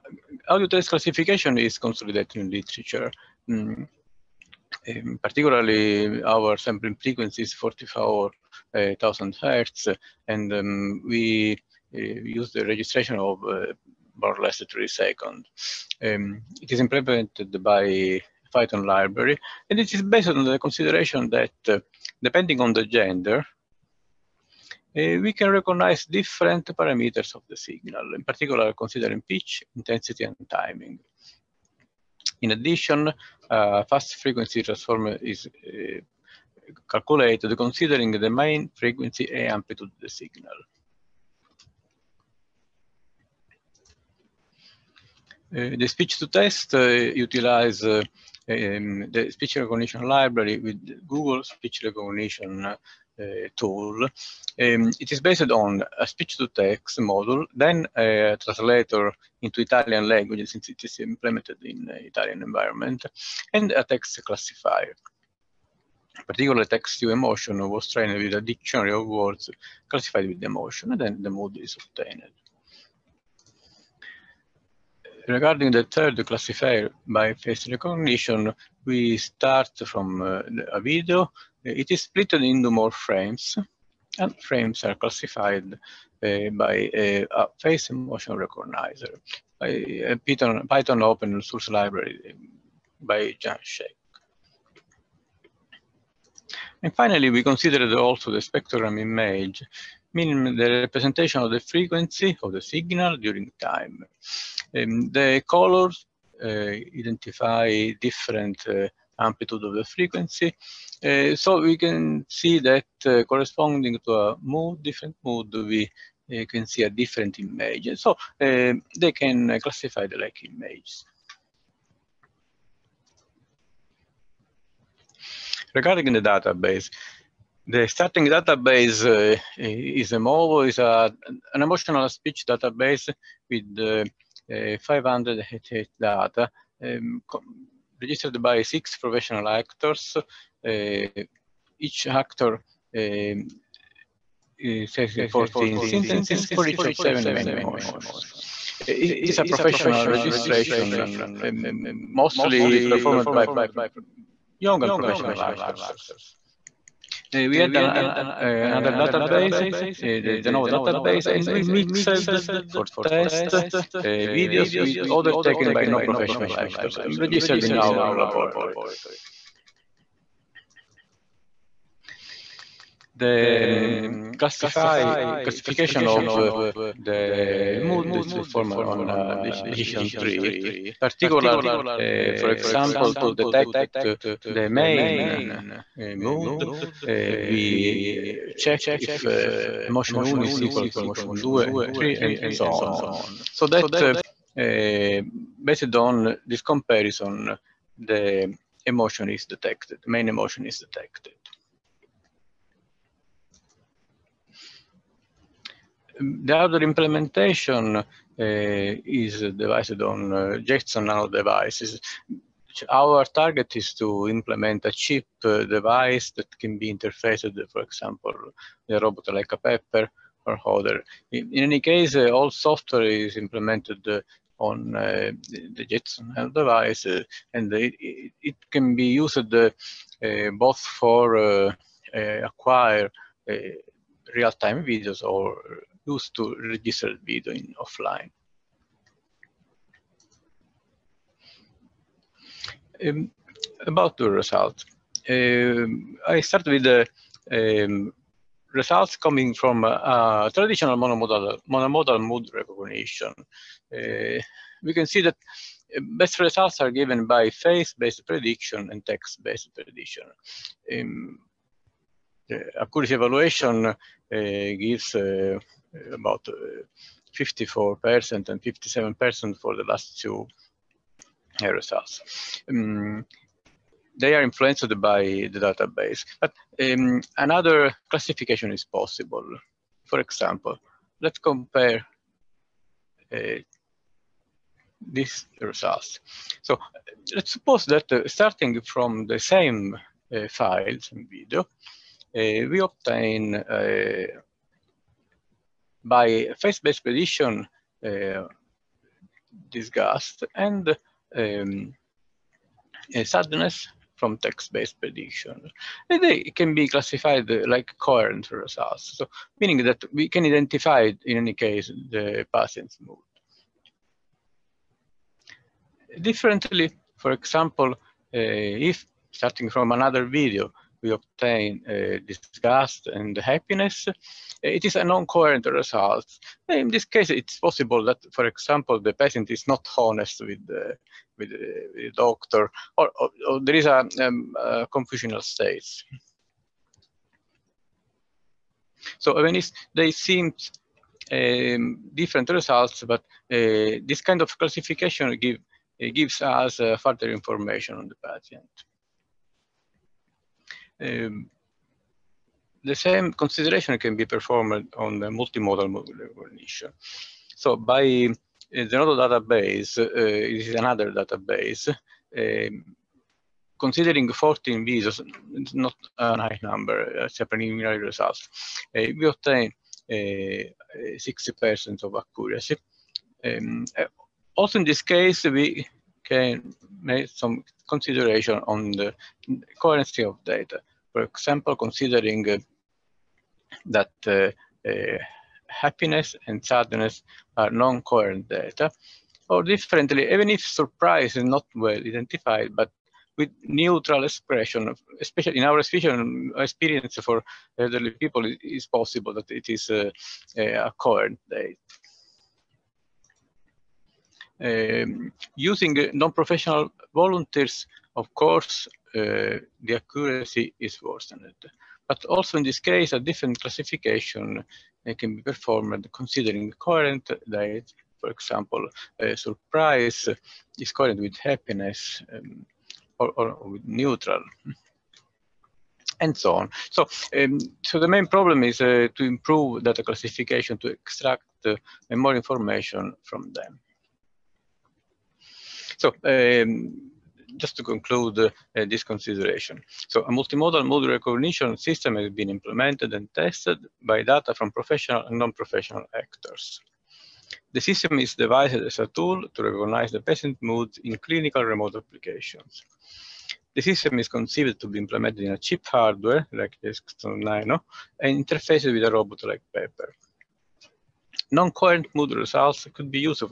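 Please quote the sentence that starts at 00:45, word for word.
Uh, the speech to test uh, utilize uh, um, the speech recognition library with Google speech recognition uh, Eh, tool.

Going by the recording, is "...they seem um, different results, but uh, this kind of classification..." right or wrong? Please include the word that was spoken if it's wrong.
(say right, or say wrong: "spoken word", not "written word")
right.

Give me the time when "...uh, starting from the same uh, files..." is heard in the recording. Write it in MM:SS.
04:48.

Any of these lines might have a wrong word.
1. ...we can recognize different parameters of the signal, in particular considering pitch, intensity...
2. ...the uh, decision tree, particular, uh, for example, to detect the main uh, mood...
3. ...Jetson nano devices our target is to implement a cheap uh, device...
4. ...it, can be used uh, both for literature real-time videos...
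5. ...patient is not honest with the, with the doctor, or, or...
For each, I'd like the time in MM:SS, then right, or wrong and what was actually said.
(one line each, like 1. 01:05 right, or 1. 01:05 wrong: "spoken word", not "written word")
1. 00:25 right
2. 02:59 right
3. 03:30 right
4. 03:48 wrong: "acquire", not "literature"
5. 05:29 right.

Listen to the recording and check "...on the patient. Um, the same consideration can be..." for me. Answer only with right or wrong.
right.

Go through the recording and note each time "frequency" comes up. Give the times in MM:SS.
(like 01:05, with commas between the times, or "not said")
00:06, 00:34, 00:38, 01:41, 01:49.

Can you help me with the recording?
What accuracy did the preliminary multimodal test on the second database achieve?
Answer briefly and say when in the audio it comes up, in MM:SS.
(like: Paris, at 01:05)
60%, at 06:10.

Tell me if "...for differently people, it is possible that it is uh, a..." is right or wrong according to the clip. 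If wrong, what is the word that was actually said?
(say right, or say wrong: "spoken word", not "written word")
wrong: "elderly", not "differently".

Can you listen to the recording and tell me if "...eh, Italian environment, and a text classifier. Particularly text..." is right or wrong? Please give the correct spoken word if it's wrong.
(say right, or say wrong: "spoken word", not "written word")
right.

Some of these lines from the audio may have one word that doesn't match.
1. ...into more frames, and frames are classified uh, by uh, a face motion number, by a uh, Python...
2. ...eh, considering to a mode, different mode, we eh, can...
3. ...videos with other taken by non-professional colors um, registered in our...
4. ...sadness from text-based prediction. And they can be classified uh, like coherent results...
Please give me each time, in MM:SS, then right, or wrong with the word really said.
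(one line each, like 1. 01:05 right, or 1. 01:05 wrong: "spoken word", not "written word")
1. 01:22 wrong: "recognizer", not "number"
2. 01:53 wrong: "corresponding", not "considering"
3. 02:44 wrong: "actors", not "colors"
4. 05:03 right.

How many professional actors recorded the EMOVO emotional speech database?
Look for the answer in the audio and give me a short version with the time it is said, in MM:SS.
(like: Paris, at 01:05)
six, at 02:18.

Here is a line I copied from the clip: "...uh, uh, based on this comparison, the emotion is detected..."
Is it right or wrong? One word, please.
right.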